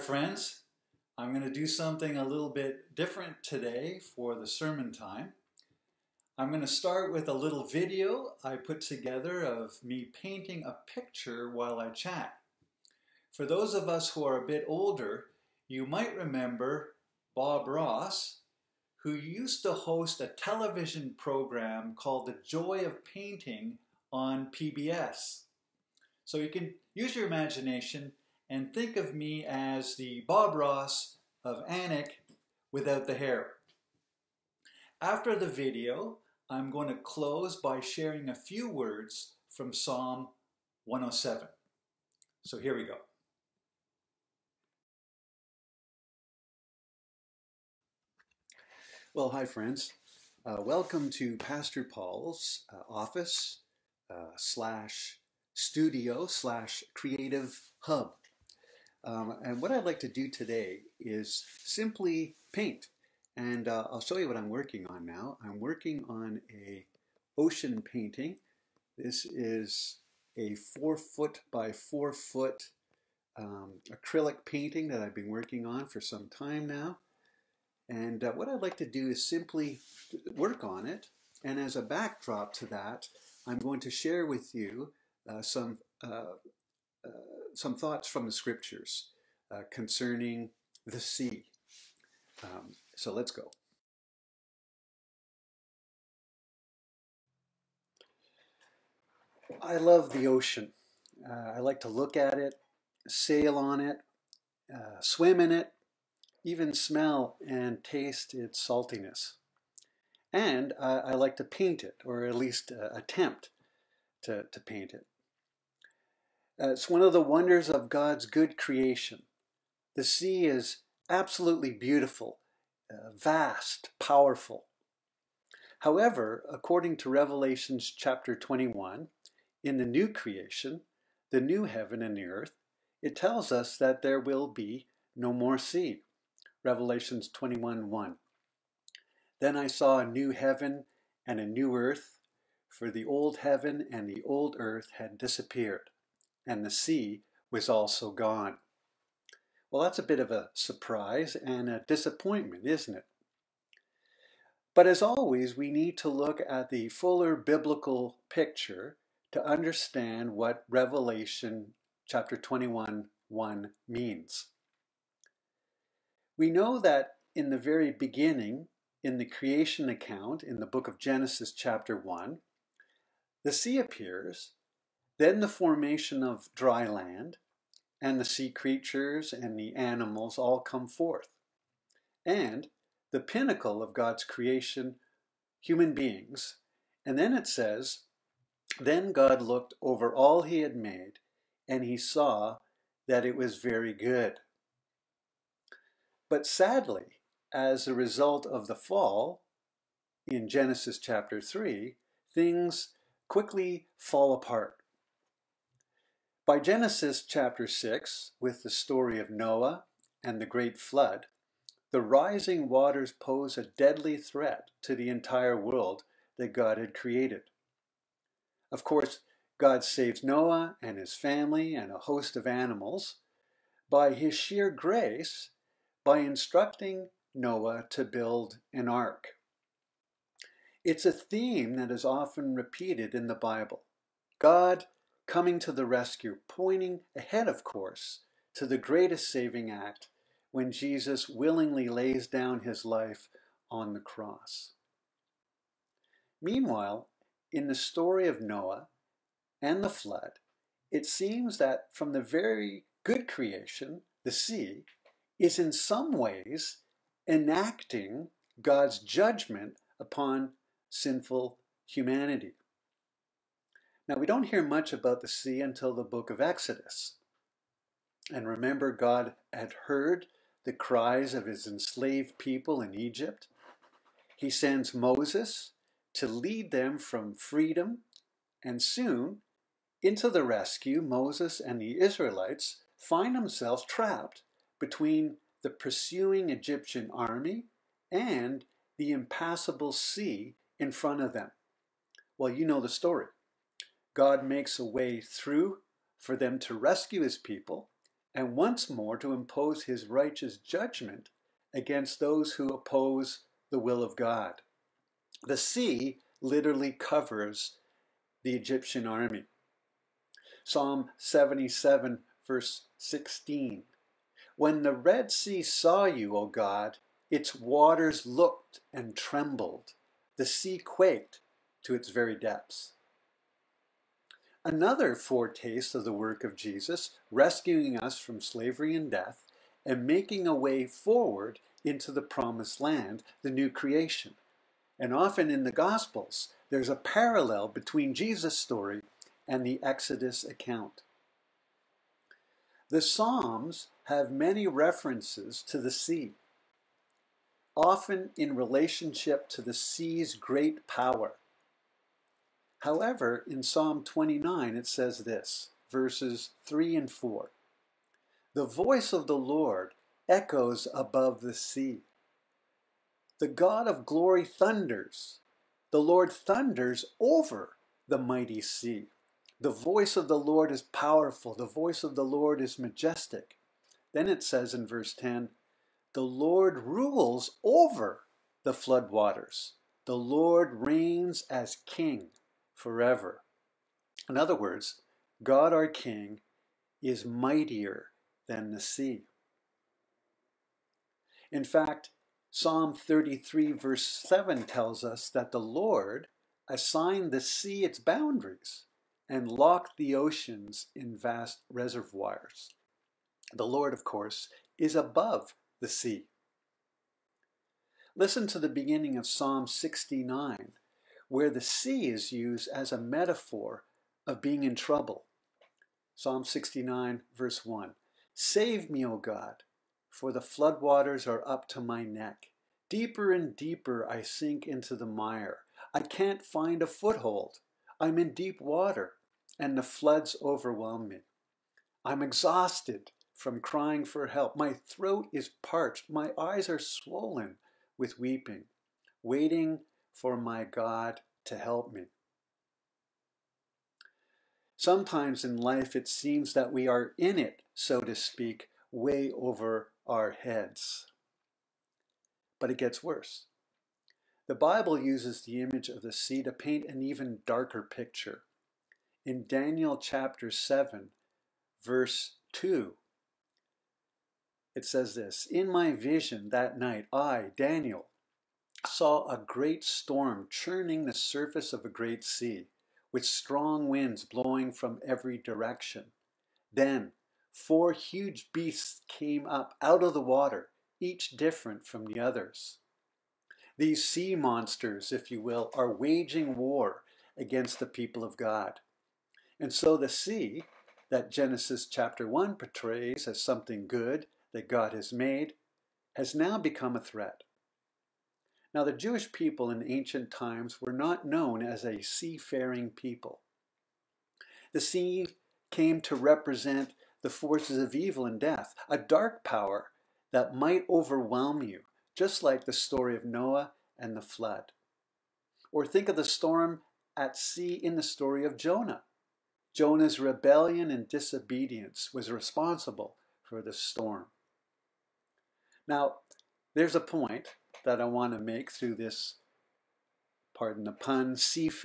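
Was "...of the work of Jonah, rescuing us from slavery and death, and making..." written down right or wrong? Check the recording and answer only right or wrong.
wrong.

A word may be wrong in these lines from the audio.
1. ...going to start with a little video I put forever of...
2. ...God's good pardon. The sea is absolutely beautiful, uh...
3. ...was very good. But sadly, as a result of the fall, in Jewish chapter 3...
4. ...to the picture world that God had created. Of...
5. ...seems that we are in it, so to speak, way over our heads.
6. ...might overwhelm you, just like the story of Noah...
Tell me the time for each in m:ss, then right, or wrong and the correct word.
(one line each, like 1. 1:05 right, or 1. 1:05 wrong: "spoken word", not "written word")
1. 0:06 wrong: "together", not "forever"
2. 1:57 wrong: "creation", not "pardon"
3. 3:13 wrong: "Genesis", not "Jewish"
4. 3:34 wrong: "entire", not "picture"
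5. 7:26 right
6. 8:30 right.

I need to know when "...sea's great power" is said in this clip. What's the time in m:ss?
5:49.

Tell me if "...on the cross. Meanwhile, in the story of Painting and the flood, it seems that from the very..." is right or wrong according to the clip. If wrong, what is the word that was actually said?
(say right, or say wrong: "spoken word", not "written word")
wrong: "Noah", not "Painting".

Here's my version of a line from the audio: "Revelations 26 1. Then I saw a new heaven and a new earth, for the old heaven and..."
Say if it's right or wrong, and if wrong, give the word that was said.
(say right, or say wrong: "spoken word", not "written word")
wrong: "21", not "26".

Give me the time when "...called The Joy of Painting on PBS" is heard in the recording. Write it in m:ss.
0:21.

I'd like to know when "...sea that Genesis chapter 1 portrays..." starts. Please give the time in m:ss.
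8:10.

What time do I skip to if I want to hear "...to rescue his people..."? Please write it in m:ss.
4:56.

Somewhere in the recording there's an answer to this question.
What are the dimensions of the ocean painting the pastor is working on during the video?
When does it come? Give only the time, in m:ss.
1:10.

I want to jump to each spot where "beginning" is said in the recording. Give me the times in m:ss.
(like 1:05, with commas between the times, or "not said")
2:47, 6:48.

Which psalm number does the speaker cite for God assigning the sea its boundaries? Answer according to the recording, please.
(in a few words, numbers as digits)
Psalm 33.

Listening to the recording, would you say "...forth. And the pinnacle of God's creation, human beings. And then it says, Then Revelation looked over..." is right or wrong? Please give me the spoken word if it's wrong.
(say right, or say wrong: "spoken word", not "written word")
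wrong: "God", not "Revelation".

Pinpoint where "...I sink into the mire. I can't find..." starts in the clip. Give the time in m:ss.
7:04.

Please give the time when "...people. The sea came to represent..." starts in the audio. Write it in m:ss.
8:22.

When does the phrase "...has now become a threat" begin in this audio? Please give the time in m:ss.
8:16.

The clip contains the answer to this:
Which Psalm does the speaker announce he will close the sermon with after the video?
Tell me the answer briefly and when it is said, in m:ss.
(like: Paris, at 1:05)
Psalm 107, at 0:39.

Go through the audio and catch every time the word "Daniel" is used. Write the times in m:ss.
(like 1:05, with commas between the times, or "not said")
7:39, 7:47.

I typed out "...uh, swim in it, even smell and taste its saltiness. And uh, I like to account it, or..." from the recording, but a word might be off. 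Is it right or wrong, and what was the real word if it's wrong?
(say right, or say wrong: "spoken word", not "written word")
wrong: "paint", not "account".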